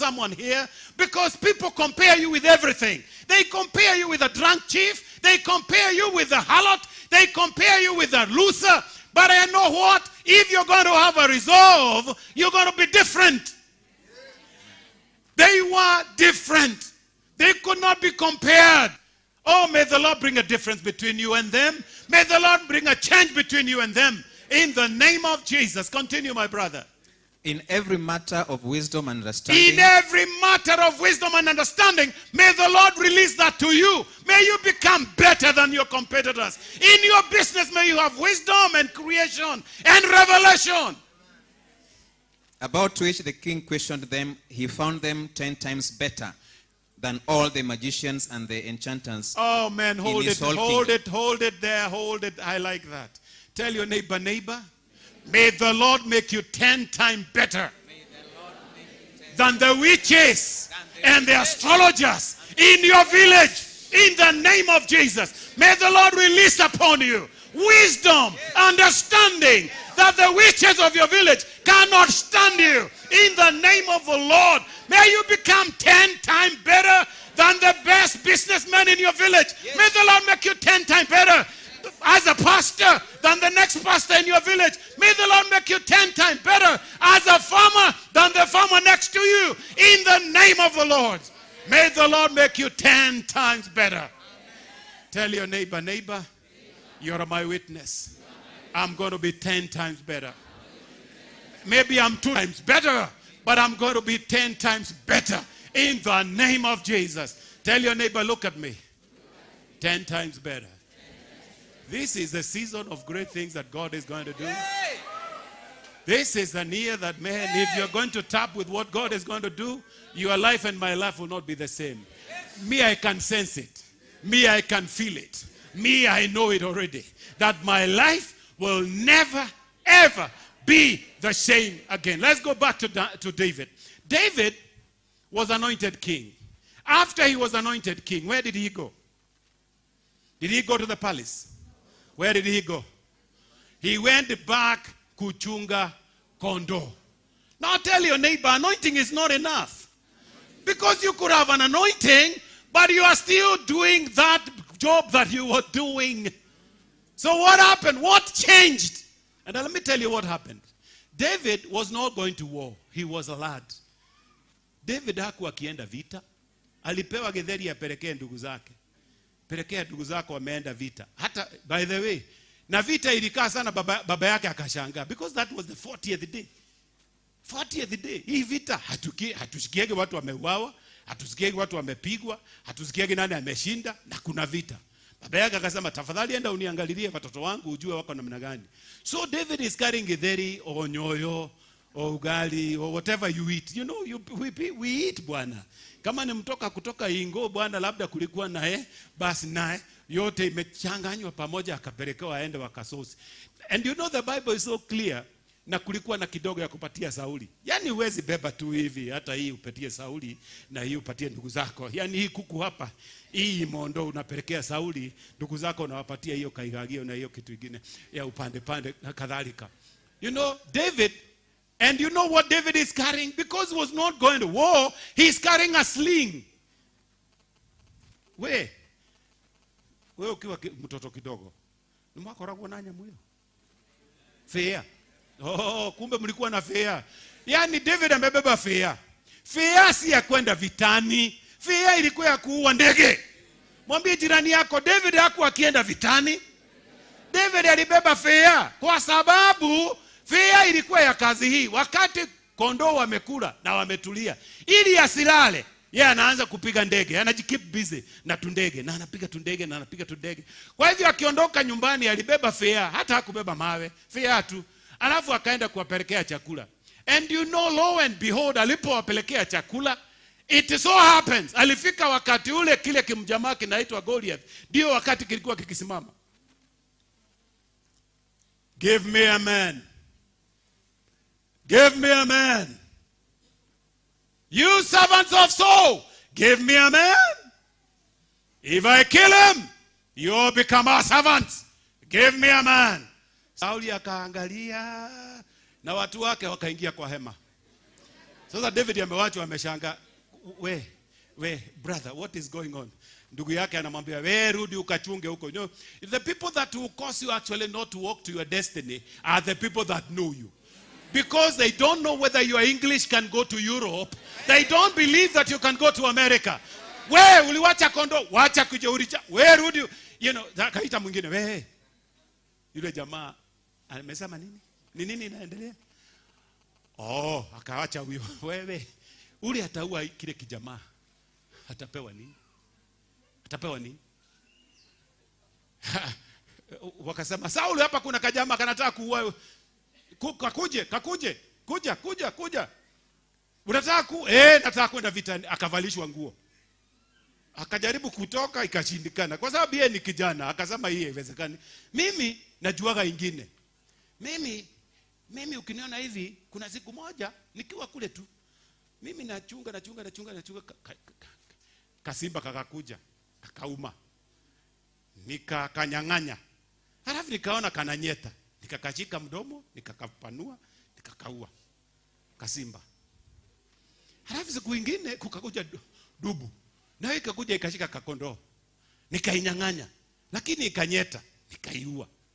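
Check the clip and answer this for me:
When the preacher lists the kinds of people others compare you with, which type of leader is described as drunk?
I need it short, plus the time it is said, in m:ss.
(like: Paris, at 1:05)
chief, at 0:04.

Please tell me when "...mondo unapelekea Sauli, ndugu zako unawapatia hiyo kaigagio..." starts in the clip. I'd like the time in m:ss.
3:33.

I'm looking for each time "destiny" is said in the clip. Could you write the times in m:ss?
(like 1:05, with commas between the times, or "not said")
5:08.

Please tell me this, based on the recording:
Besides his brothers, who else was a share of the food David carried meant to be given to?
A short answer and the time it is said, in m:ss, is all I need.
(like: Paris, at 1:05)
Saul, at 3:26.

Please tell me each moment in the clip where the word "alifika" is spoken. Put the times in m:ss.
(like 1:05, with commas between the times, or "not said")
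4:31.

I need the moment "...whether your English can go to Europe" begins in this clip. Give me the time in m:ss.
5:12.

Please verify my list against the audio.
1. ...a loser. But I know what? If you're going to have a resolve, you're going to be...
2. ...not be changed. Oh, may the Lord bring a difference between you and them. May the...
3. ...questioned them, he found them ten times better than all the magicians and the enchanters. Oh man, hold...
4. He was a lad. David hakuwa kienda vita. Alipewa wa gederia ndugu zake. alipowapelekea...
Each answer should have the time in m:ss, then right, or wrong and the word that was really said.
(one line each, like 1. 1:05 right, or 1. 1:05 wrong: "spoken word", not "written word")
1. 0:08 right
2. 0:17 wrong: "compared", not "changed"
3. 0:43 right
4. 2:42 wrong: "pelekea", not "alipowapelekea".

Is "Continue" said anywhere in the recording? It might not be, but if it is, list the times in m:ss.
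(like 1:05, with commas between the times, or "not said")
0:25.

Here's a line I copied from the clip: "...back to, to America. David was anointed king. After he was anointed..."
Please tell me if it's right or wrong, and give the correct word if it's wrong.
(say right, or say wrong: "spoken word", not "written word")
wrong: "David", not "America".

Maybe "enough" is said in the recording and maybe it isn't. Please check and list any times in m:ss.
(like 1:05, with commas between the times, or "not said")
2:29.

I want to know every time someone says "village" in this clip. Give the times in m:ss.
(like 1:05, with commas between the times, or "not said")
1:03, 1:11, 1:19, 1:24.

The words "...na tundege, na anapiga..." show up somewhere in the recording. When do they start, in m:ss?
4:18.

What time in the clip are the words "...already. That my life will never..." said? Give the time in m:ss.
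2:06.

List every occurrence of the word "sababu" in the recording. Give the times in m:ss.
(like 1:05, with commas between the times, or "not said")
4:09, 5:49.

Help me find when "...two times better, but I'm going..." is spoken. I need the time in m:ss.
1:42.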